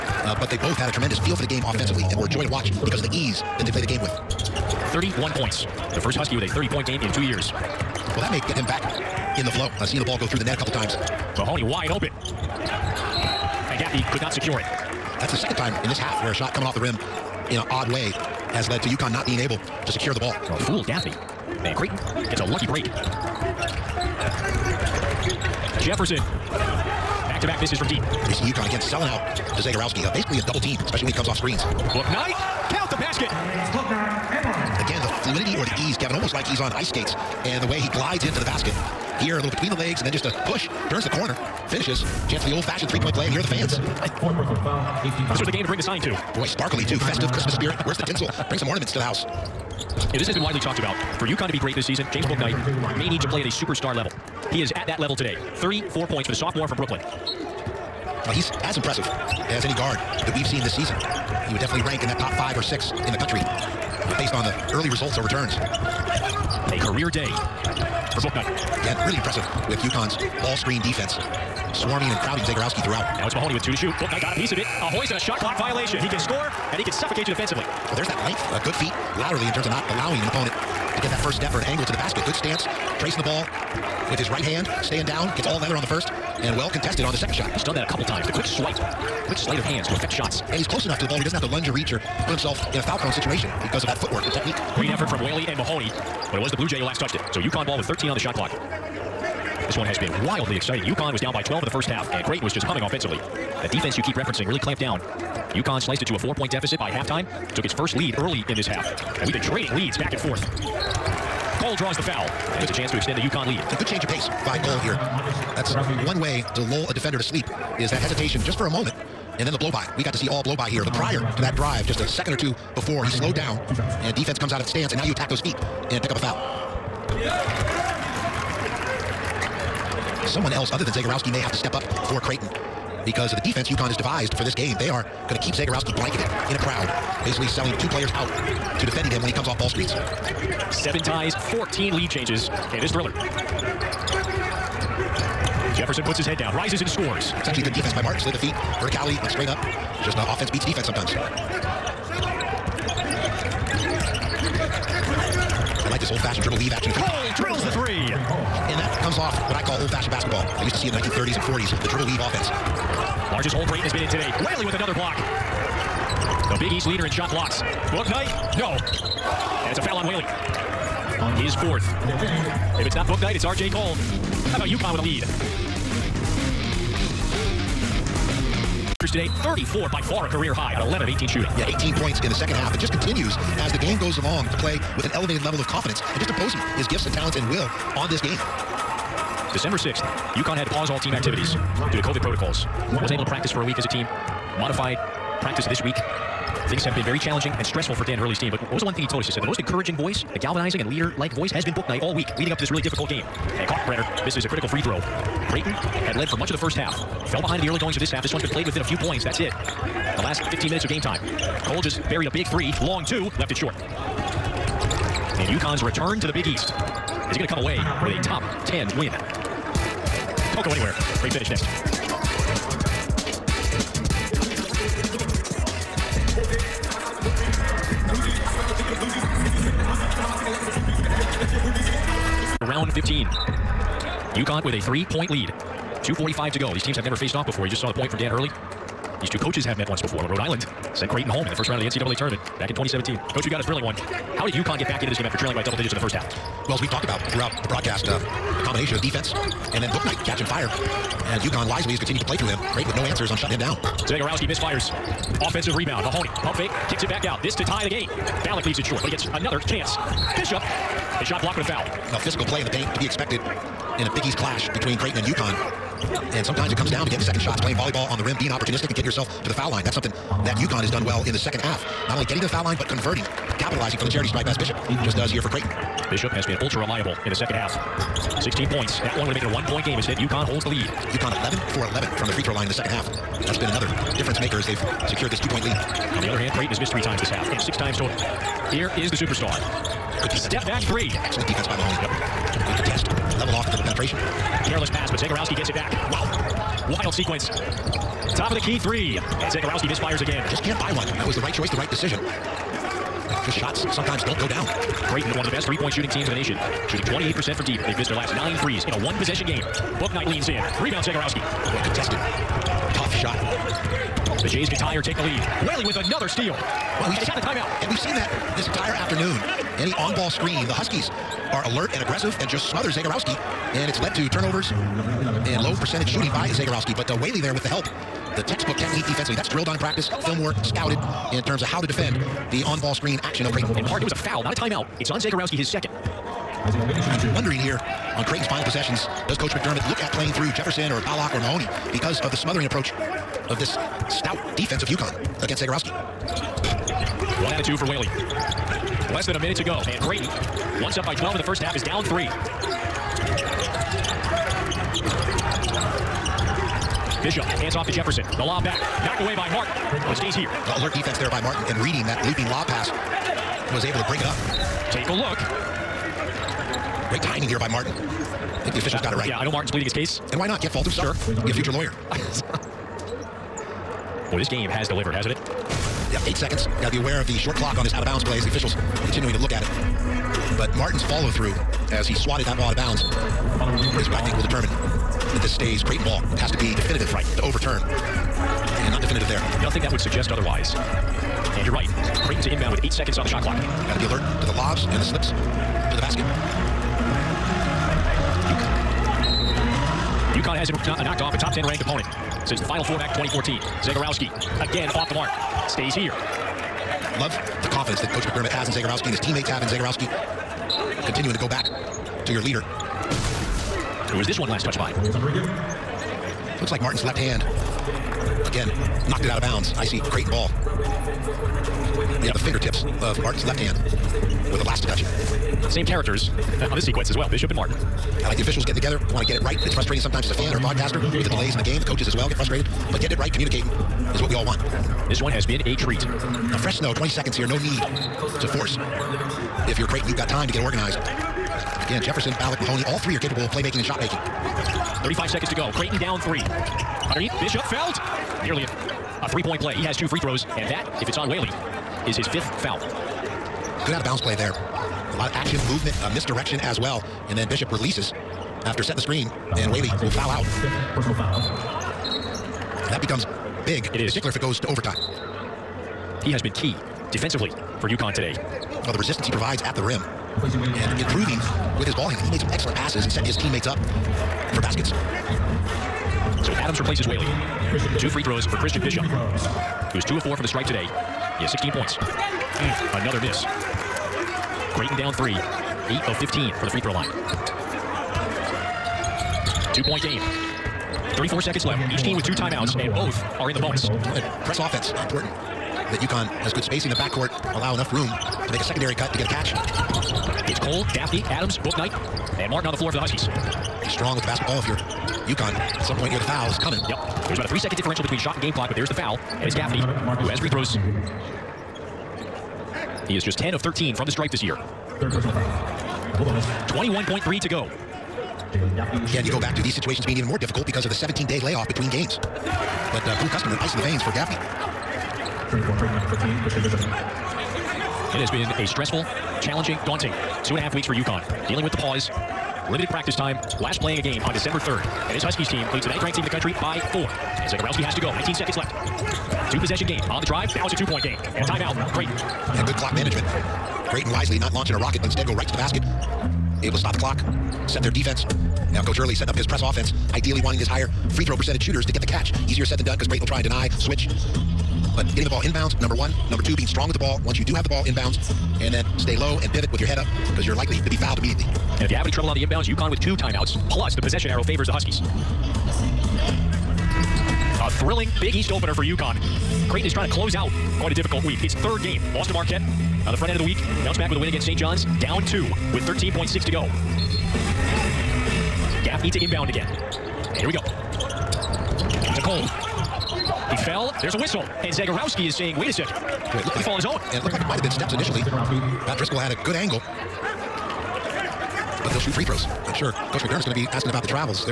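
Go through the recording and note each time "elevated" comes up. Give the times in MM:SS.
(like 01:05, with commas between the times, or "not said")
03:05.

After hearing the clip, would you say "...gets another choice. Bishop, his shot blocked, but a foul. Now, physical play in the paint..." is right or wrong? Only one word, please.
wrong.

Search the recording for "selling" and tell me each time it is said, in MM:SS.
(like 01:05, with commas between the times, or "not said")
00:28, 02:17.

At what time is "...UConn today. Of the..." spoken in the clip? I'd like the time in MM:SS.
07:47.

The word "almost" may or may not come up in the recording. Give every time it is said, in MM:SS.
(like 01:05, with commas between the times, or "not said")
00:36.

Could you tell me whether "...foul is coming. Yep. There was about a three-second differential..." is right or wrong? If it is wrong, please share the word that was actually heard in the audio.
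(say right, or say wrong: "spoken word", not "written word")
right.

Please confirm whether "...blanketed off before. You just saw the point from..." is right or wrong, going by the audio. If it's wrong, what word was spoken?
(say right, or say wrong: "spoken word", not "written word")
wrong: "faced", not "blanketed".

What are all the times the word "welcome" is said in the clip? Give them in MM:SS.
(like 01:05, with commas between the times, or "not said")
not said.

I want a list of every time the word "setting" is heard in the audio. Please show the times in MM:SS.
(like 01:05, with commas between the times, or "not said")
07:38, 09:09.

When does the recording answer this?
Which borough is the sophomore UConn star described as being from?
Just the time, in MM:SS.
00:56.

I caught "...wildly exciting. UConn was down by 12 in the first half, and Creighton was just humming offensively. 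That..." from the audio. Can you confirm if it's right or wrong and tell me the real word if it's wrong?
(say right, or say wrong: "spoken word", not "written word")
right.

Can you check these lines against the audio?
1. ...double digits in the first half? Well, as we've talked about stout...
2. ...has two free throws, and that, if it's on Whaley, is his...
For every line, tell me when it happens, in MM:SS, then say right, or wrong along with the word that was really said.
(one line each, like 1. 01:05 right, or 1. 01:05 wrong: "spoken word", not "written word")
1. 04:05 wrong: "throughout", not "stout"
2. 07:29 right.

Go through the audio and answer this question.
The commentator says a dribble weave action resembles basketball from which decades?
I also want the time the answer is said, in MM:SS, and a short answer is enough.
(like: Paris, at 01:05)
1930s and 40s, at 02:40.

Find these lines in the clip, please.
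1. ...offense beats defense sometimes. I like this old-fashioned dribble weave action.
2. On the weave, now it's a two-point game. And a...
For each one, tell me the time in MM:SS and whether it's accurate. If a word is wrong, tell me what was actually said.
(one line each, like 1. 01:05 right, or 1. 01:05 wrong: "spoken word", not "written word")
1. 02:30 right
2. 09:00 wrong: "drive", not "weave".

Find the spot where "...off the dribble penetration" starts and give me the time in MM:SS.
04:53.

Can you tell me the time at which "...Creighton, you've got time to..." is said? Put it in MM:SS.
07:19.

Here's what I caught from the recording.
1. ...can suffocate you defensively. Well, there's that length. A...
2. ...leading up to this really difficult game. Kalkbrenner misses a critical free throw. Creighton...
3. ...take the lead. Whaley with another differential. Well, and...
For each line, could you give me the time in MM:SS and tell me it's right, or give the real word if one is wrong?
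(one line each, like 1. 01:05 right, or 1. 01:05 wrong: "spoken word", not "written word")
1. 01:16 right
2. 03:22 right
3. 05:15 wrong: "steal", not "differential".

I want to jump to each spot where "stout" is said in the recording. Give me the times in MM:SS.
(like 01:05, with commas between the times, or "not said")
05:44.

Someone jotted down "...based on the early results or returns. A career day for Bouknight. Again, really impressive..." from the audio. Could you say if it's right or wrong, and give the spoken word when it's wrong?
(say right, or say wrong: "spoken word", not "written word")
right.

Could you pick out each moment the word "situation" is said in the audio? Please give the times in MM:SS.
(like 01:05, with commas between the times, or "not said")
01:33, 08:39.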